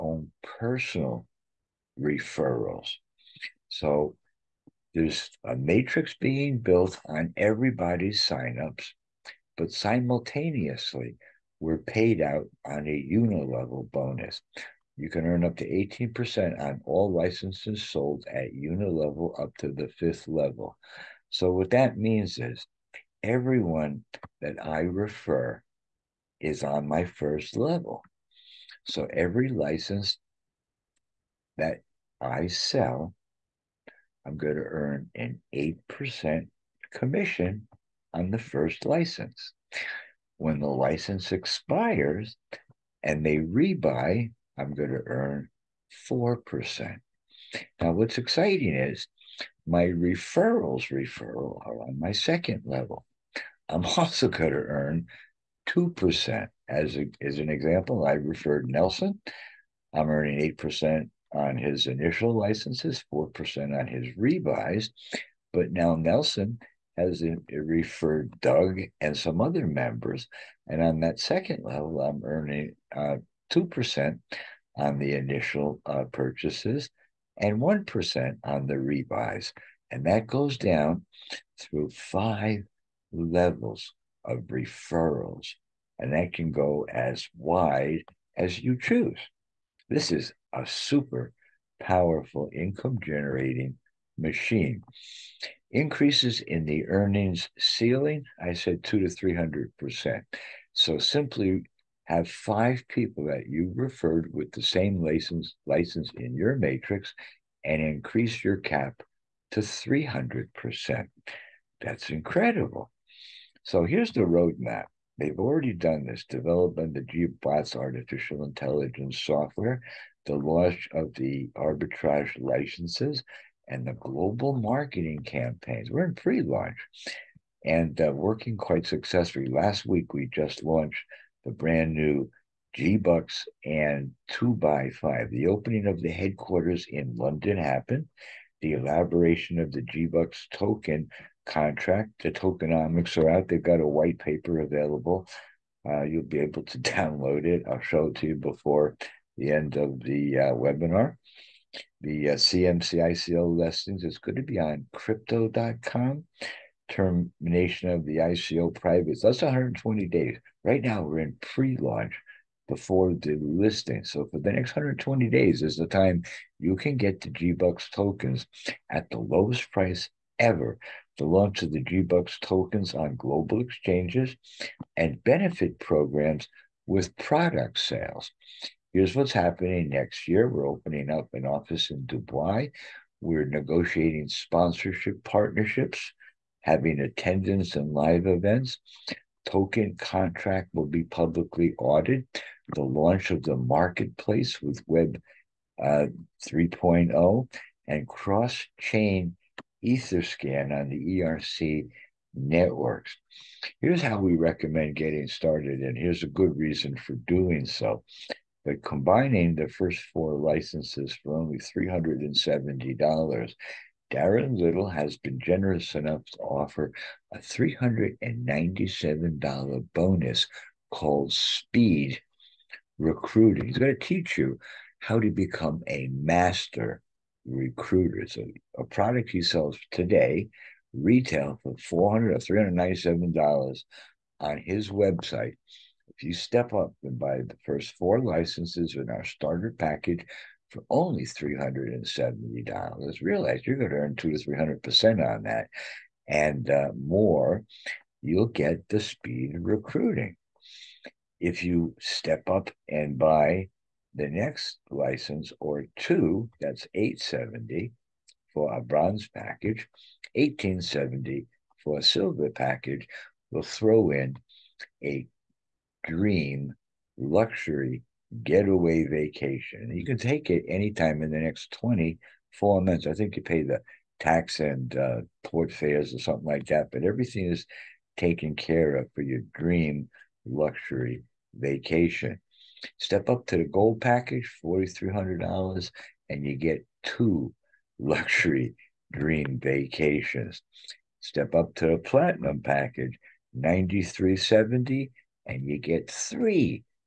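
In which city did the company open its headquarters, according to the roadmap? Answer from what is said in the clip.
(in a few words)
London.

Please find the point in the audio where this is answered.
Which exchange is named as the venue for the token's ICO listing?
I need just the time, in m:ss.
2:34.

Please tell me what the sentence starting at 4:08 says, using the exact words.
You'll get the speed of recruiting.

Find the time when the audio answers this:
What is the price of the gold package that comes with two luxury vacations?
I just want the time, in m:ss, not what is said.
4:44.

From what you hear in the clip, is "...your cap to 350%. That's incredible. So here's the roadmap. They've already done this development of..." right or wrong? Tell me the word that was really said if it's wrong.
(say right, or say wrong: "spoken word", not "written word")
wrong: "300", not "350".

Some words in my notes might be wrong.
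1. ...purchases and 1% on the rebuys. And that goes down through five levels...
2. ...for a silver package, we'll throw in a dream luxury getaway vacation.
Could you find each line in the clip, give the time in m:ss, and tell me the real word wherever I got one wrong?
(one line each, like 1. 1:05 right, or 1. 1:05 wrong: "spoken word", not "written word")
1. 1:16 right
2. 4:21 right.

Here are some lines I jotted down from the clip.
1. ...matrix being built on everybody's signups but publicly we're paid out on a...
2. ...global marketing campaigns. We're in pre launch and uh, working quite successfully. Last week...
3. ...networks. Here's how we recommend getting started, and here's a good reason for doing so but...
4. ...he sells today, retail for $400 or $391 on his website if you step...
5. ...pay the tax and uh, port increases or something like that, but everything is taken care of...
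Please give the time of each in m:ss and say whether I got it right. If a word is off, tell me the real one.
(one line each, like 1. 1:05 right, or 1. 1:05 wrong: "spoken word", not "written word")
1. 0:05 wrong: "simultaneously", not "publicly"
2. 2:03 right
3. 3:22 right
4. 3:49 wrong: "397", not "391"
5. 4:33 wrong: "fares", not "increases".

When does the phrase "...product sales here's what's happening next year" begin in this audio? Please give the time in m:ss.
2:57.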